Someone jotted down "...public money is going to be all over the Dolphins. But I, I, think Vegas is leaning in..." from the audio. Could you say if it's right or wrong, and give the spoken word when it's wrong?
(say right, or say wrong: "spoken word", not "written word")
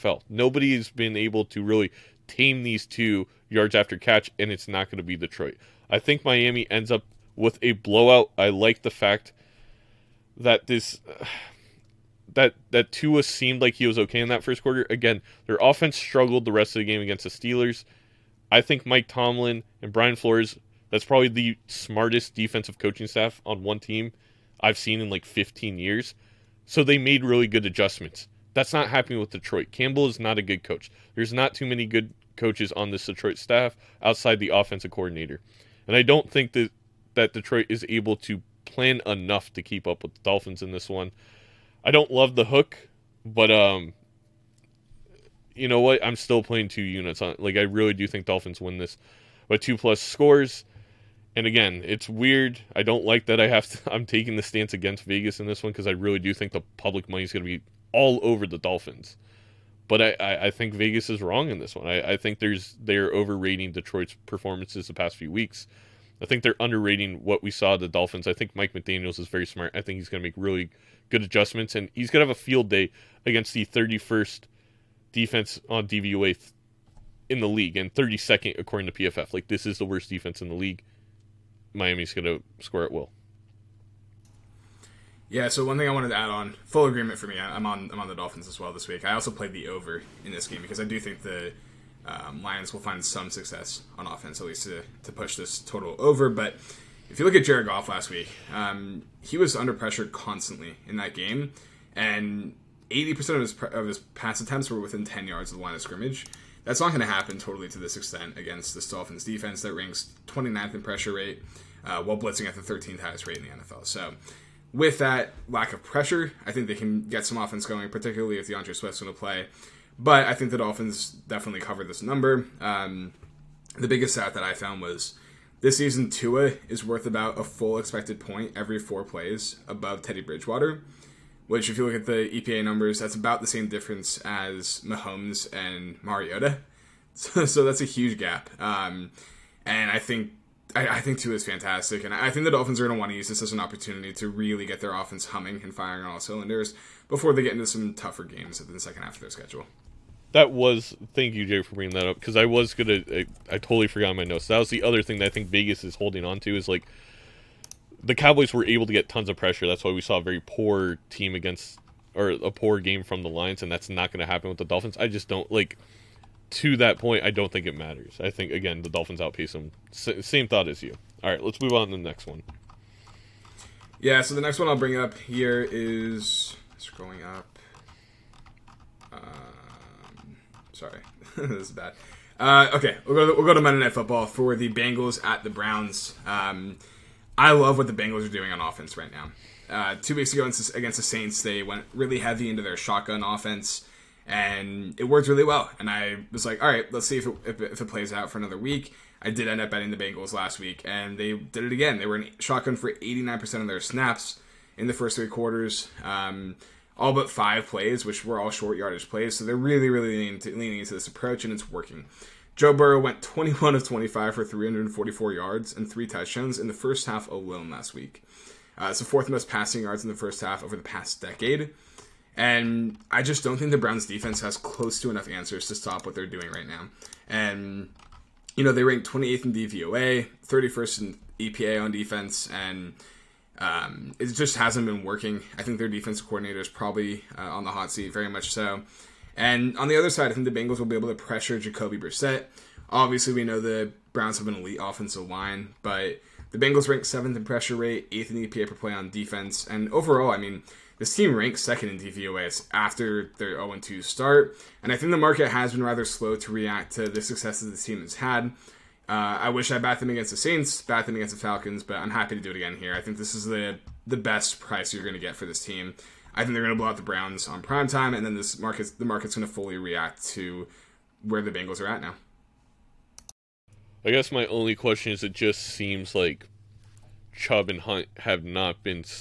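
wrong: "wrong", not "leaning".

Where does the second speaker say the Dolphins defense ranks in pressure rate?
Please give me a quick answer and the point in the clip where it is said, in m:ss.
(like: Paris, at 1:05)
29th, at 1:50.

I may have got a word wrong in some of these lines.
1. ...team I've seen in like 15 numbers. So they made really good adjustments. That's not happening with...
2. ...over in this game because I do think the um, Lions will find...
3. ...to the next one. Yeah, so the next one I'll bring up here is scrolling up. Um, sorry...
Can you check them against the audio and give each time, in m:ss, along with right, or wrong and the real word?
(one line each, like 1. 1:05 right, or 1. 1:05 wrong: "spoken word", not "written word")
1. 0:23 wrong: "years", not "numbers"
2. 1:29 right
3. 2:51 right.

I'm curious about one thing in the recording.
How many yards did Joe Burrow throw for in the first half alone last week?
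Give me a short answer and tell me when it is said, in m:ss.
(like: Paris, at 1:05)
344, at 3:34.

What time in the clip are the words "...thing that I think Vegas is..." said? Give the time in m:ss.
2:35.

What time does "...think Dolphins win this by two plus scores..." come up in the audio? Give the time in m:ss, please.
0:48.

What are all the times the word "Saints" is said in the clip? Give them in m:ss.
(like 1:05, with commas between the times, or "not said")
3:11, 4:20.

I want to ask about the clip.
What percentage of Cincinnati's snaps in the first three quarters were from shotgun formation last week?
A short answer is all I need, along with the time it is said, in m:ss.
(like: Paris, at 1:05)
89%, at 3:22.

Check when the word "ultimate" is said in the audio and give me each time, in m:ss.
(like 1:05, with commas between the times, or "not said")
not said.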